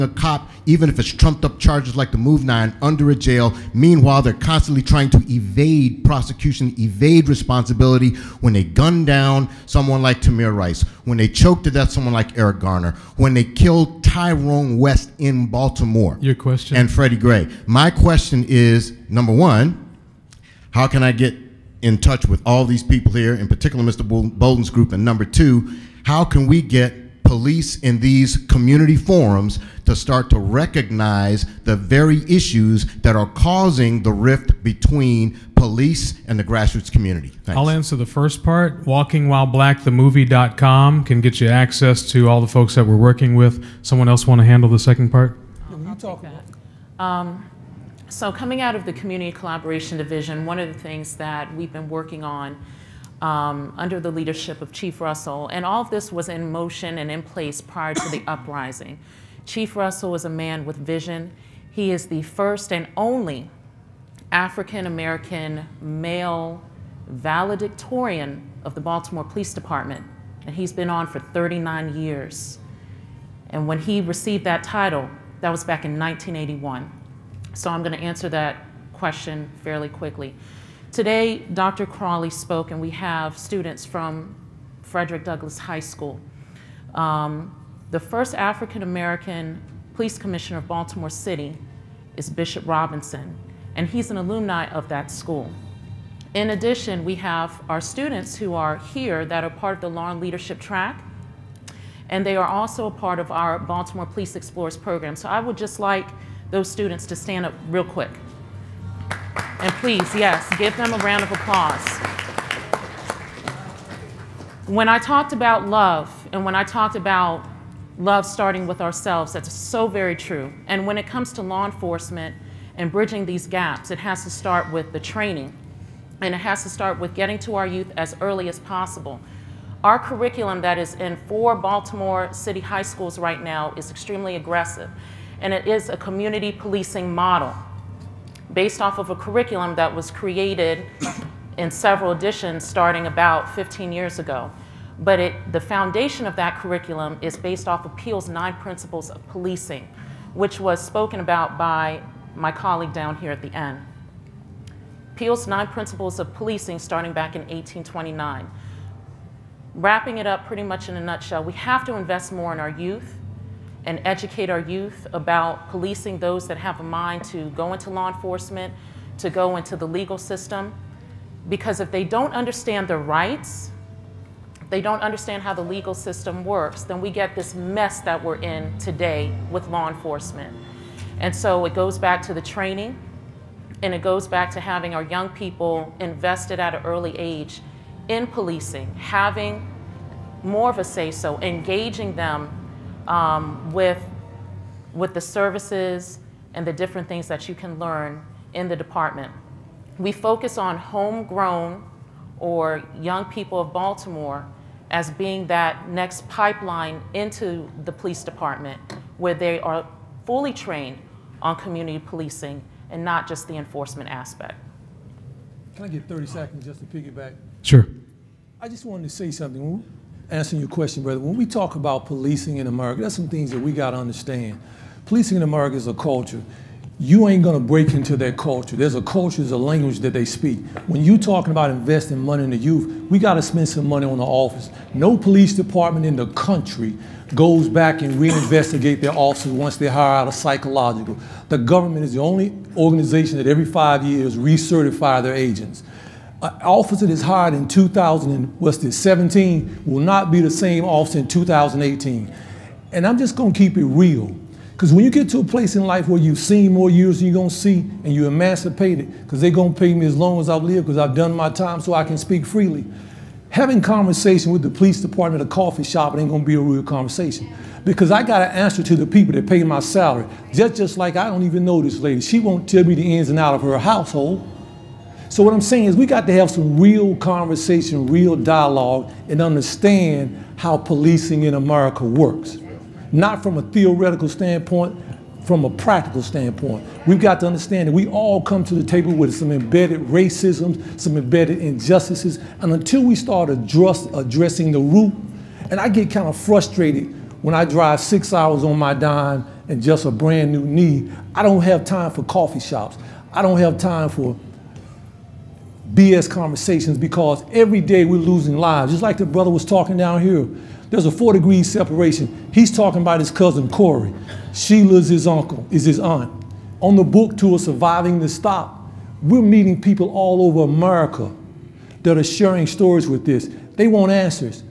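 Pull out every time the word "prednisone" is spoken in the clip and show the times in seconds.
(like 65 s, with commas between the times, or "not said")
not said.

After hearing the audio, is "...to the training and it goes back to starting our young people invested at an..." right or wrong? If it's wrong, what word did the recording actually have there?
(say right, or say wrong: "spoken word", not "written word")
wrong: "having", not "starting".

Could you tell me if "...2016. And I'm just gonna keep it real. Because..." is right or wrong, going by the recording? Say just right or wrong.
wrong.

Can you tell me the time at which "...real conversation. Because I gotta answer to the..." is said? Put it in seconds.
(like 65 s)
266 s.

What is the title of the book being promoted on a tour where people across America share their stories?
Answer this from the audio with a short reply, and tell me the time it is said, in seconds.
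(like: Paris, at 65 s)
Surviving the Stop, at 317 s.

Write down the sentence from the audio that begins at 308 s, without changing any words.
Just like the brother was talking down here, there's a four degree separation.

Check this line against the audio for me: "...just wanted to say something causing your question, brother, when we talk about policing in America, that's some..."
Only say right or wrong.
wrong.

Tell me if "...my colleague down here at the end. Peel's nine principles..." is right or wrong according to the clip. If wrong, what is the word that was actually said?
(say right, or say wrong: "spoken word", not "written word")
right.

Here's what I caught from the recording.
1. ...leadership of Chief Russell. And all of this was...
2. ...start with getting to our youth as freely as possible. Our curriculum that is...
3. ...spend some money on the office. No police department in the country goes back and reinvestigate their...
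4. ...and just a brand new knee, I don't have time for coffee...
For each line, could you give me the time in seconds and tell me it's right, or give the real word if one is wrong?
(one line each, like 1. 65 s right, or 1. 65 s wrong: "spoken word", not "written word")
1. 54 s right
2. 126 s wrong: "early", not "freely"
3. 233 s right
4. 299 s right.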